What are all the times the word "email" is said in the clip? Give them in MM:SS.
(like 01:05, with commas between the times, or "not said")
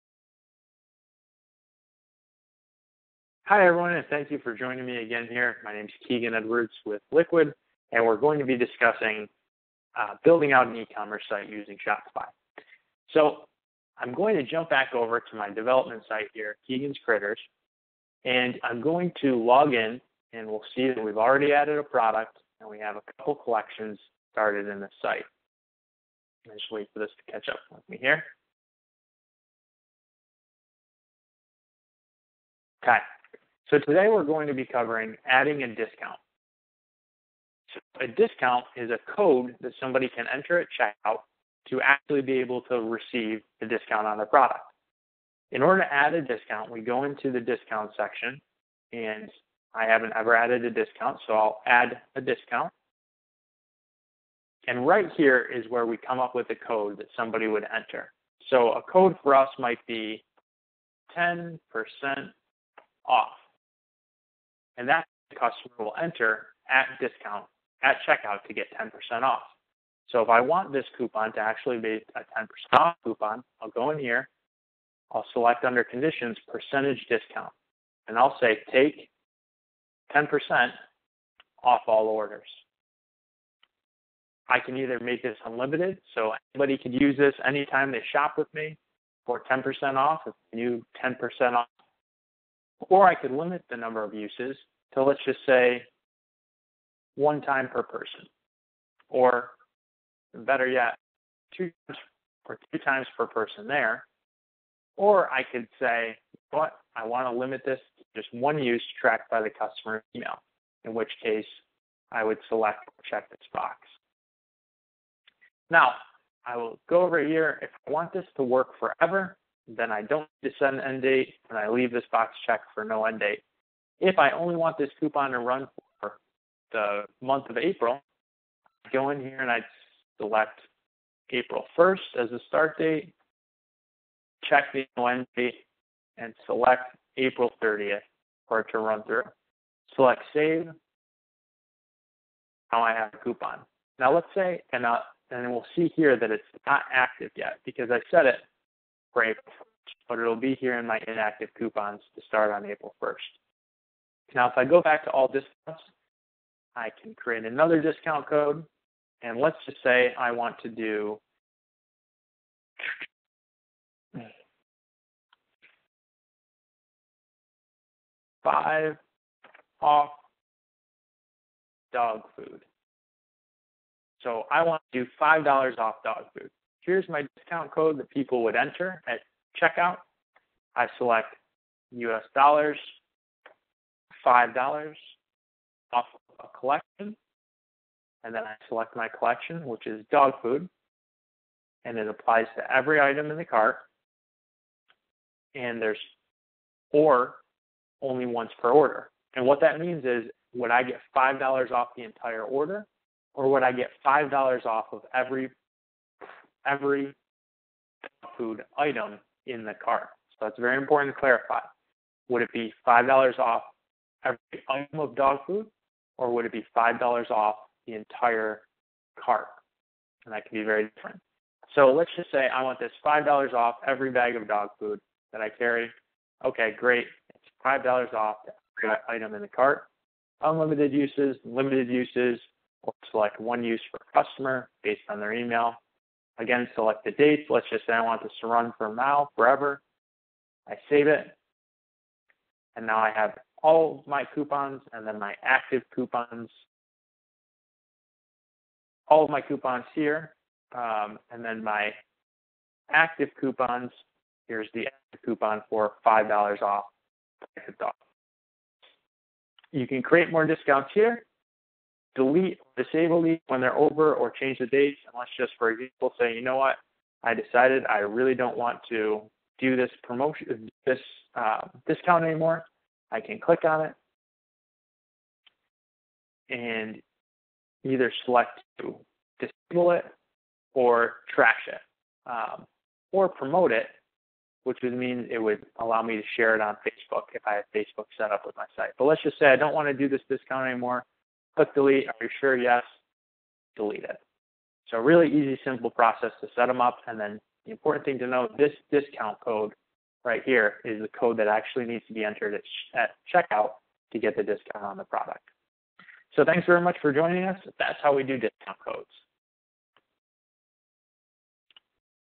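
01:50, 03:55.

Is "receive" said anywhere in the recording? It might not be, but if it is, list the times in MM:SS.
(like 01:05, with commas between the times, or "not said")
00:42.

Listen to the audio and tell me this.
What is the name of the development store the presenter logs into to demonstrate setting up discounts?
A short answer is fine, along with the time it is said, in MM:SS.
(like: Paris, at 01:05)
Keegan's Critters, at 00:16.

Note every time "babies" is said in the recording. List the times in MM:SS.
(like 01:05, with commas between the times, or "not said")
not said.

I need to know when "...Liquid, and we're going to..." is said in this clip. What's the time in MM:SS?
00:07.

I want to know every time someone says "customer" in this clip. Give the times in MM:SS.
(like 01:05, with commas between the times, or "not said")
01:05, 01:49, 03:54.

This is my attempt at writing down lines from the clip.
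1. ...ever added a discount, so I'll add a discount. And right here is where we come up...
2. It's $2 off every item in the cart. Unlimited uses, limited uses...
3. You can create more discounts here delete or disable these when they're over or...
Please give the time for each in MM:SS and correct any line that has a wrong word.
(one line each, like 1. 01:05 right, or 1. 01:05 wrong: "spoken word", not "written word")
1. 00:50 right
2. 03:47 wrong: "5", not "2"
3. 04:19 right.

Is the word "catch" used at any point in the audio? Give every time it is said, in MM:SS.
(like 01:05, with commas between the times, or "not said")
00:27.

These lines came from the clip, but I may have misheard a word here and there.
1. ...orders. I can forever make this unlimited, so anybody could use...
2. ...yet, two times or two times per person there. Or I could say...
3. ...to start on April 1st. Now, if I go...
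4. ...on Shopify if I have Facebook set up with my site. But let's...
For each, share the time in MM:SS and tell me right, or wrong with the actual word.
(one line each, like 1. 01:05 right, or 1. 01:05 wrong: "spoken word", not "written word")
1. 01:22 wrong: "either", not "forever"
2. 01:40 right
3. 02:32 right
4. 04:46 wrong: "Facebook", not "Shopify".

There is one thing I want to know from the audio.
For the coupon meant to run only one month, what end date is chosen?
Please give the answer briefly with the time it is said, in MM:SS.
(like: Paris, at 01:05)
April 30th, at 02:17.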